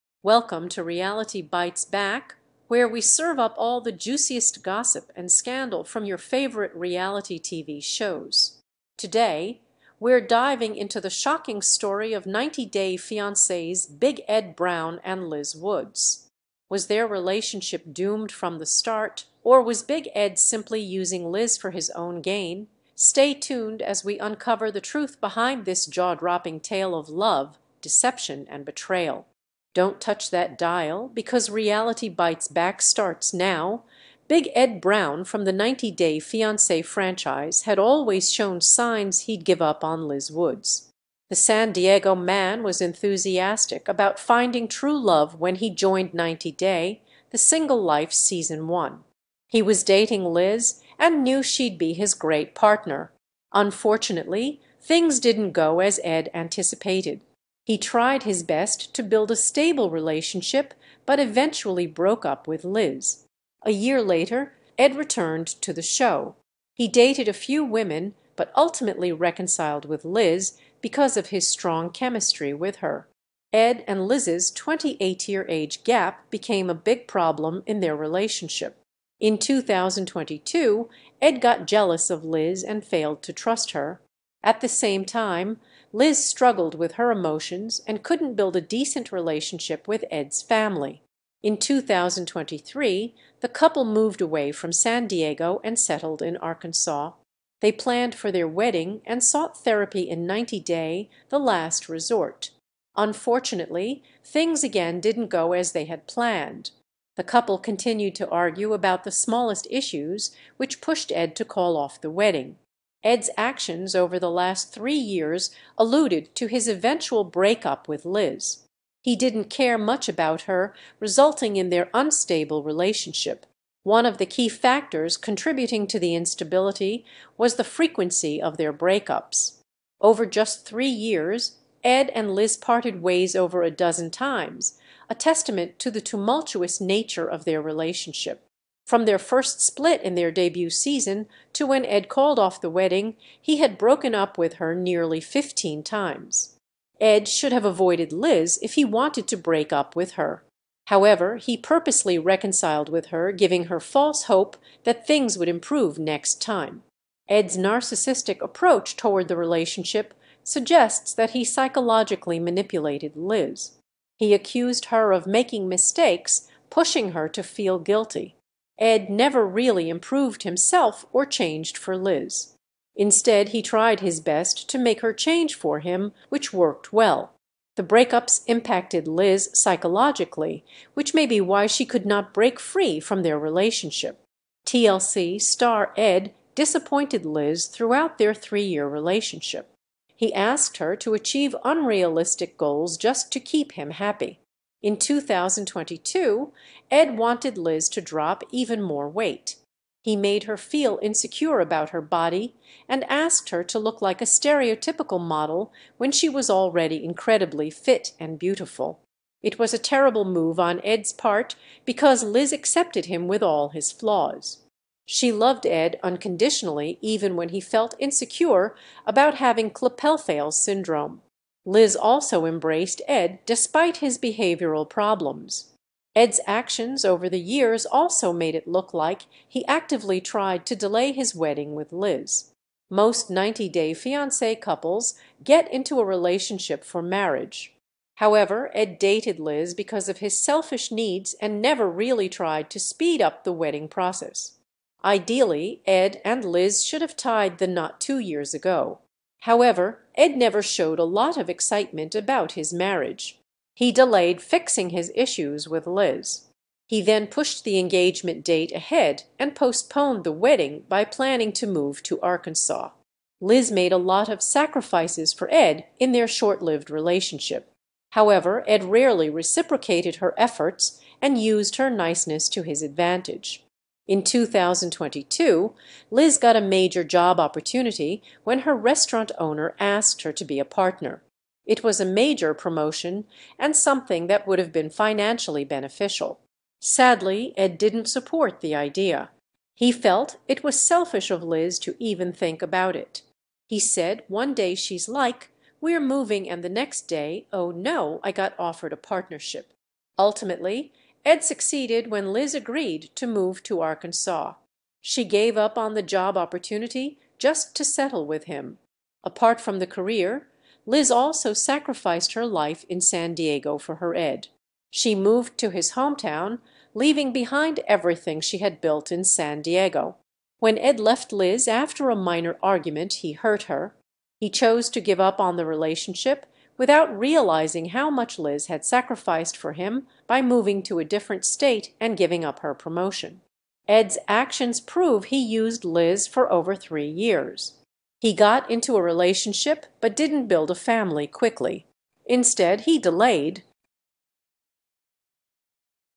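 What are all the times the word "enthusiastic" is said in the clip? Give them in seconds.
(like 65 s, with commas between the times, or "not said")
42 s.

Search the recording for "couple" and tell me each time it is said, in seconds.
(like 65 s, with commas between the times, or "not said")
93 s, 107 s, 234 s.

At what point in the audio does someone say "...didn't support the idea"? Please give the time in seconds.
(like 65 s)
287 s.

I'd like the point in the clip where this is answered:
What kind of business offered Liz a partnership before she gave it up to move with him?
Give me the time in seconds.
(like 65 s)
278 s.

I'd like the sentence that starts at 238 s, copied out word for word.
However, Ed dated Liz because of his selfish needs and never really tried to speed up the wedding process.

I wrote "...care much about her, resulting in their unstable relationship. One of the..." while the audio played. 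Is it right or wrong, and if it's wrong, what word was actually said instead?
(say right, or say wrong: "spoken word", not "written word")
right.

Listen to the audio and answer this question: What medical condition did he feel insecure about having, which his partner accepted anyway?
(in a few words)
Klippel-Feil syndrome.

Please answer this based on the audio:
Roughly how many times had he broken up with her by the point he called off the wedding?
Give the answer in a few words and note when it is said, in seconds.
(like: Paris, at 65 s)
nearly 15, at 144 s.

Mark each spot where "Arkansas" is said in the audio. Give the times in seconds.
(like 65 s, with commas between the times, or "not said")
96 s, 262 s, 303 s.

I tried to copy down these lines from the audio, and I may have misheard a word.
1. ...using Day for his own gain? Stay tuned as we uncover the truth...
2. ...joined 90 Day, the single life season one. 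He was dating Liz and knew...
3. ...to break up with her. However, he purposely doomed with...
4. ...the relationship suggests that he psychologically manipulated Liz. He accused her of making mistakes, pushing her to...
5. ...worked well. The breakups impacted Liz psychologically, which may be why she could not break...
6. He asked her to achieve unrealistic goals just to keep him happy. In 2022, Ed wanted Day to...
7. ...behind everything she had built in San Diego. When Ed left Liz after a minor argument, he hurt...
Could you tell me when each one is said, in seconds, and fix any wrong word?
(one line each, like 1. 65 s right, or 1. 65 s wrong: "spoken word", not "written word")
1. 20 s wrong: "Liz", not "Day"
2. 45 s right
3. 149 s wrong: "reconciled", not "doomed"
4. 159 s right
5. 176 s right
6. 190 s wrong: "Liz", not "Day"
7. 317 s right.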